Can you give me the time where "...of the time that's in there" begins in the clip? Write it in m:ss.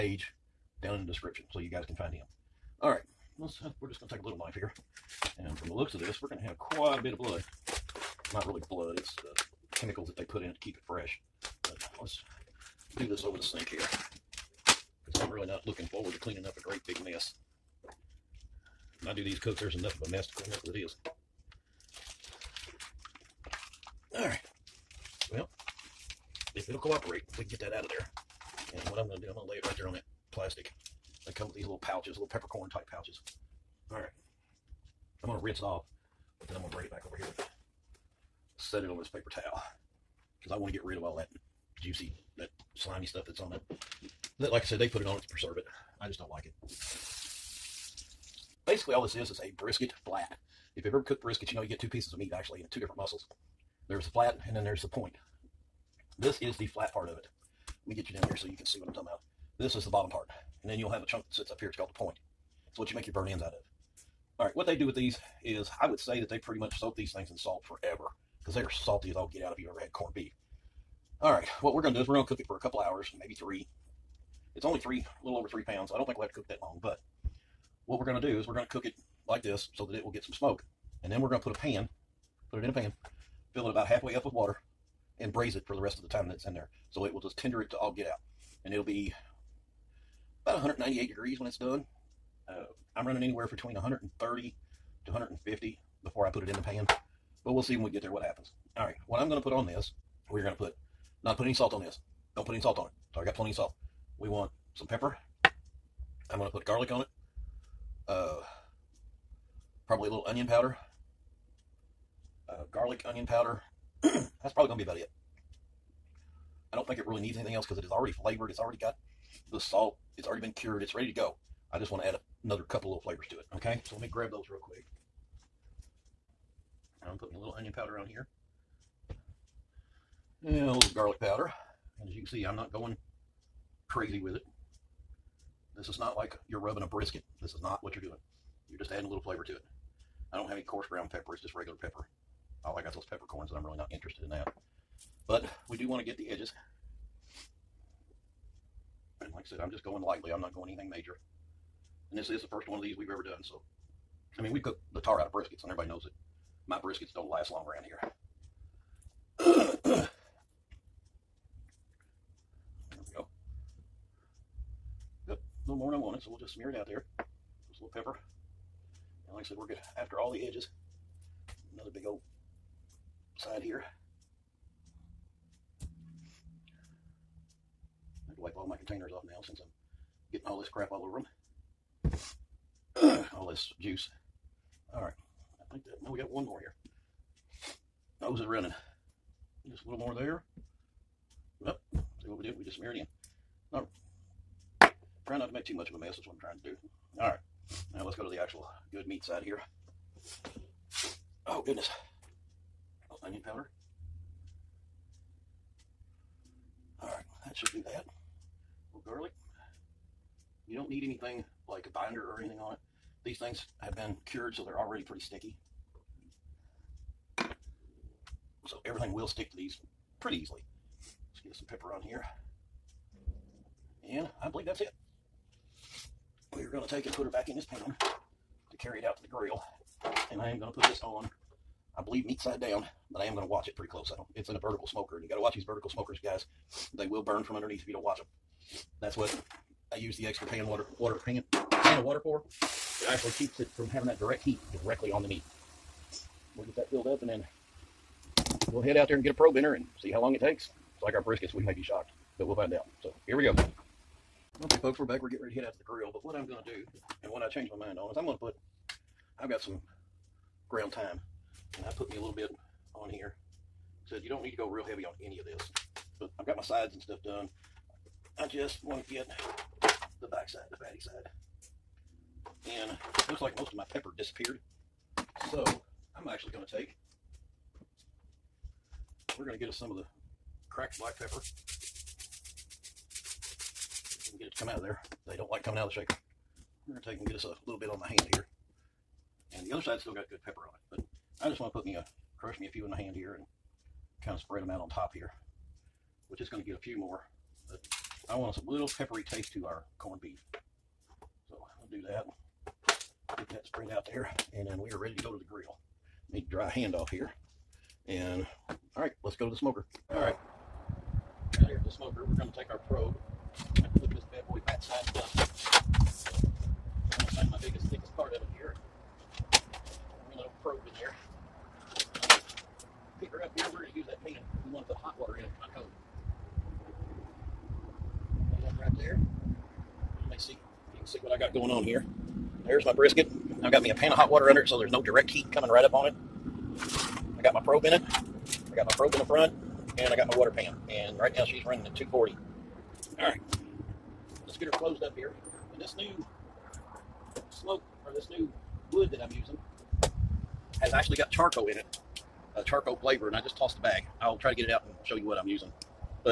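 1:25.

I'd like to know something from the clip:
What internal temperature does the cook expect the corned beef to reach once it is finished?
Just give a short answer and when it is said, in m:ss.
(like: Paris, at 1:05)
198 degrees, at 1:30.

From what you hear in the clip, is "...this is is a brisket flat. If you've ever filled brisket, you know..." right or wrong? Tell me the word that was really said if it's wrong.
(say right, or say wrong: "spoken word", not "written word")
wrong: "cooked", not "filled".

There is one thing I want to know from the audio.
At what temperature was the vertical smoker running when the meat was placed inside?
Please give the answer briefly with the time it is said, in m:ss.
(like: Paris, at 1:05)
240, at 5:41.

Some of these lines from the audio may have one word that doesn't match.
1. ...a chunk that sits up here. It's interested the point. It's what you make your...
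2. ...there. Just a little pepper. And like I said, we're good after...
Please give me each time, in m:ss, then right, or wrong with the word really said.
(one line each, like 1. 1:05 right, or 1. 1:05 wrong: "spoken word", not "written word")
1. 1:01 wrong: "called", not "interested"
2. 2:46 right.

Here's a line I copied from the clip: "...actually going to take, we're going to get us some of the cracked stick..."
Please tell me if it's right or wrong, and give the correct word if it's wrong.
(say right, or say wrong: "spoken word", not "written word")
wrong: "black", not "stick".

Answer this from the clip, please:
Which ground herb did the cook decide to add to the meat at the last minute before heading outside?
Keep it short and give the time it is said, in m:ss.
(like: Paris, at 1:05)
Thyme, at 4:20.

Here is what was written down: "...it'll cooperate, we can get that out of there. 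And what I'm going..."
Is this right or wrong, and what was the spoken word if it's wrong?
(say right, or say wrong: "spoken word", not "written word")
right.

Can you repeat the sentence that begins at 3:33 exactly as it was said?
These things have been cured, so they're already pretty sticky.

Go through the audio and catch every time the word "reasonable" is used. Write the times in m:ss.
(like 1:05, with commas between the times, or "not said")
not said.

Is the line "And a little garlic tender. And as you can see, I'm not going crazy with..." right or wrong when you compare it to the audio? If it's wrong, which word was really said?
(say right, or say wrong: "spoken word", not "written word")
wrong: "powder", not "tender".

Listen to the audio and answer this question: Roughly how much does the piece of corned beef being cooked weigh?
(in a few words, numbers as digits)
A little over 3 pounds.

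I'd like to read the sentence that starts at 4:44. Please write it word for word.
get it to come out of there they don't like coming out of the shaker.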